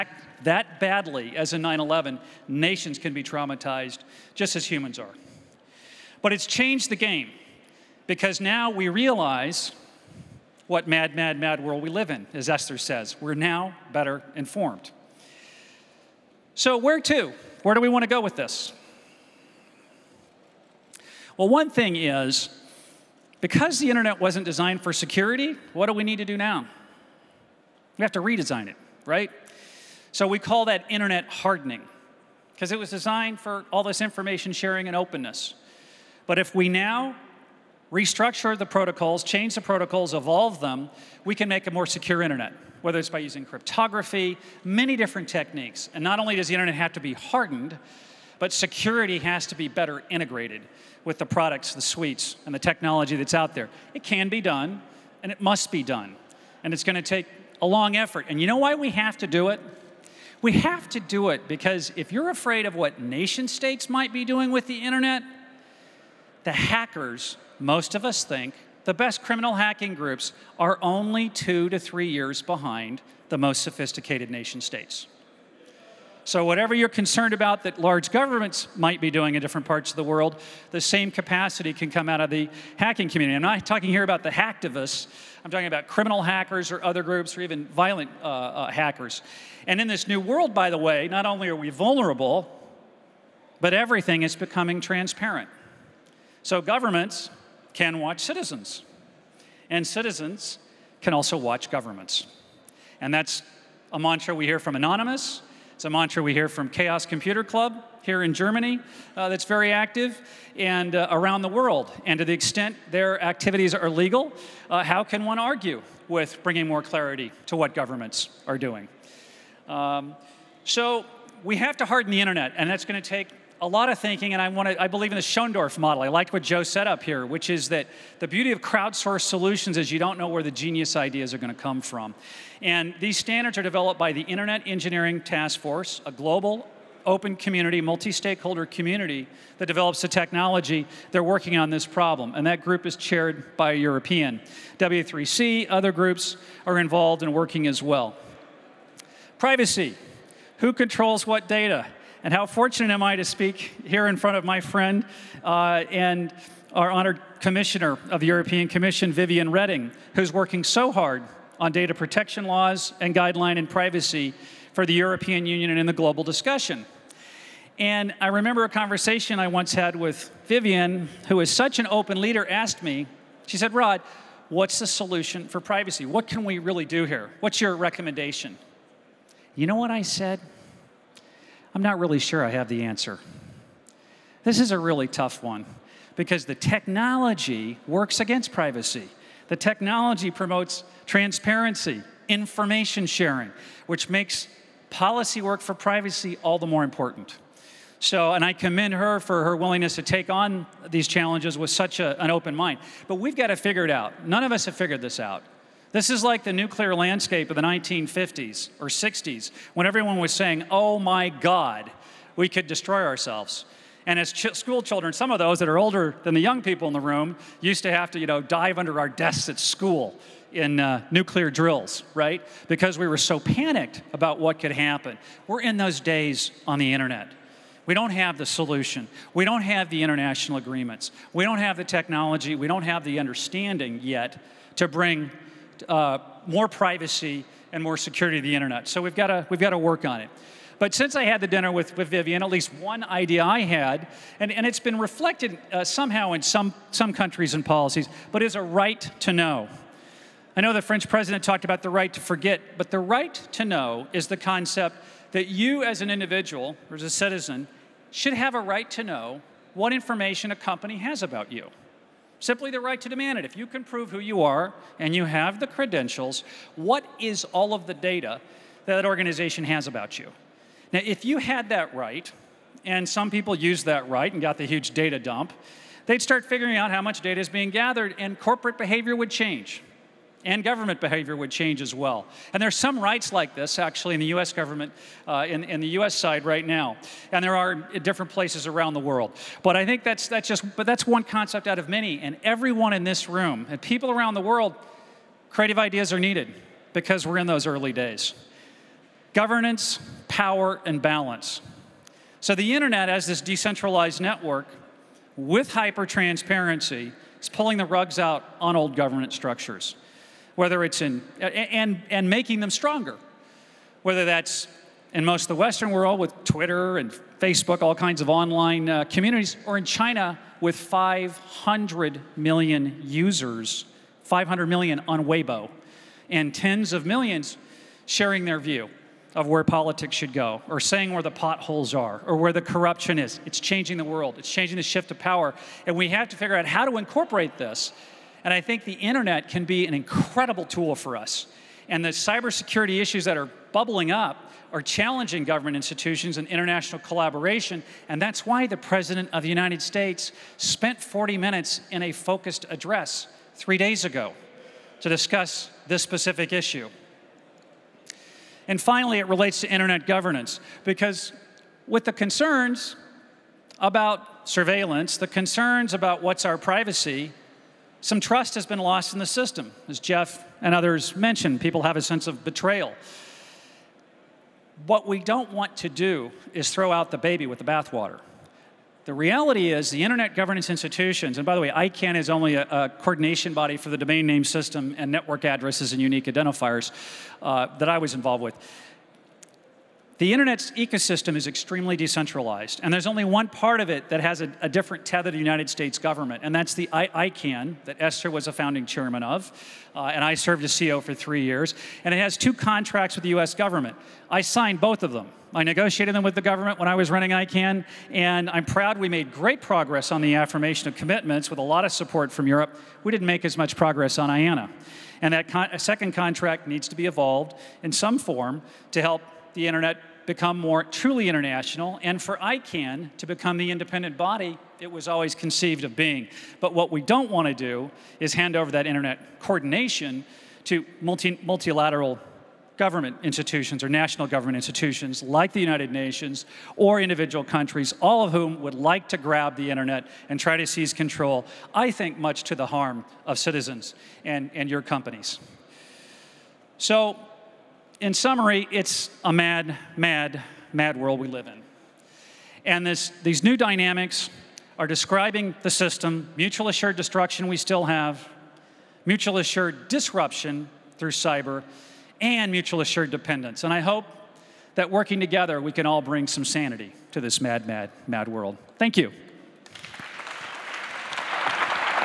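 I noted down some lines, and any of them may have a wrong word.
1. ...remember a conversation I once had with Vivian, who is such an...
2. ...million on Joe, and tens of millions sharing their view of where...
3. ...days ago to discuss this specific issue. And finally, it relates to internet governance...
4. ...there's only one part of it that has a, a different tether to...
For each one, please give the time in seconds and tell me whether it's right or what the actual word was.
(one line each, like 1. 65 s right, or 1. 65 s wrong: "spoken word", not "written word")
1. 168 s right
2. 324 s wrong: "Weibo", not "Joe"
3. 353 s right
4. 392 s right.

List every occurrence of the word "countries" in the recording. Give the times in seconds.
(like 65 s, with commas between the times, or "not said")
247 s, 437 s.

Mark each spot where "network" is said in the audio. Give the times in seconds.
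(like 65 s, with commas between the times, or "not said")
304 s, 385 s.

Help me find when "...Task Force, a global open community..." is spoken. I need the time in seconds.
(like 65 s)
135 s.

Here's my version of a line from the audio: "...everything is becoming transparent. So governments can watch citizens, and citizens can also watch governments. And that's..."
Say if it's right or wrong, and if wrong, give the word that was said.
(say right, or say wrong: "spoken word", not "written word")
right.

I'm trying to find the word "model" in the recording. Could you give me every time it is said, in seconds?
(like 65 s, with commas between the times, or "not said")
125 s.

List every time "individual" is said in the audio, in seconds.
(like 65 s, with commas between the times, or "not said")
256 s, 436 s.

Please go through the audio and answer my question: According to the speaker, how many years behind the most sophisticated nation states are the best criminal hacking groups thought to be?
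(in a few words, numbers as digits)
2 to 3 years.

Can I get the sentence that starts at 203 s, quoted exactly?
But we've got to figure it out.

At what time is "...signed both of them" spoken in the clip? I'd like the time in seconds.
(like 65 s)
404 s.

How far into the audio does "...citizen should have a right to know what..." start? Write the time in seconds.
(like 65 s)
257 s.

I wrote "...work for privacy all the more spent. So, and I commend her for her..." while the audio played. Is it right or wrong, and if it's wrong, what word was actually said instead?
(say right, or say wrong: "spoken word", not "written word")
wrong: "important", not "spent".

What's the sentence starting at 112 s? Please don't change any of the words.
And to the extent their activities are legal, uh, how can one argue with bringing more clarity to what governments are doing?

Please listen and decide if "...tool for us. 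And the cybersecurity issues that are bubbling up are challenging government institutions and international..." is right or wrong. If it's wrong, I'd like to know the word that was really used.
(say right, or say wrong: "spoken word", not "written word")
right.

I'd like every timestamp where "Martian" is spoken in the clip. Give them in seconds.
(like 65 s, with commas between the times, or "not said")
not said.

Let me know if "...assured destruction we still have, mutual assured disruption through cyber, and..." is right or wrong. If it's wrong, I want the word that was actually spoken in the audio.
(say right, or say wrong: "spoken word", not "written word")
right.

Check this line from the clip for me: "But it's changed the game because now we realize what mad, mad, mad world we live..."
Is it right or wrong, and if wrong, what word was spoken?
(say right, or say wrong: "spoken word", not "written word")
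right.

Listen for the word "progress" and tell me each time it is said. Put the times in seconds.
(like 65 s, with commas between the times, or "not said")
409 s, 413 s.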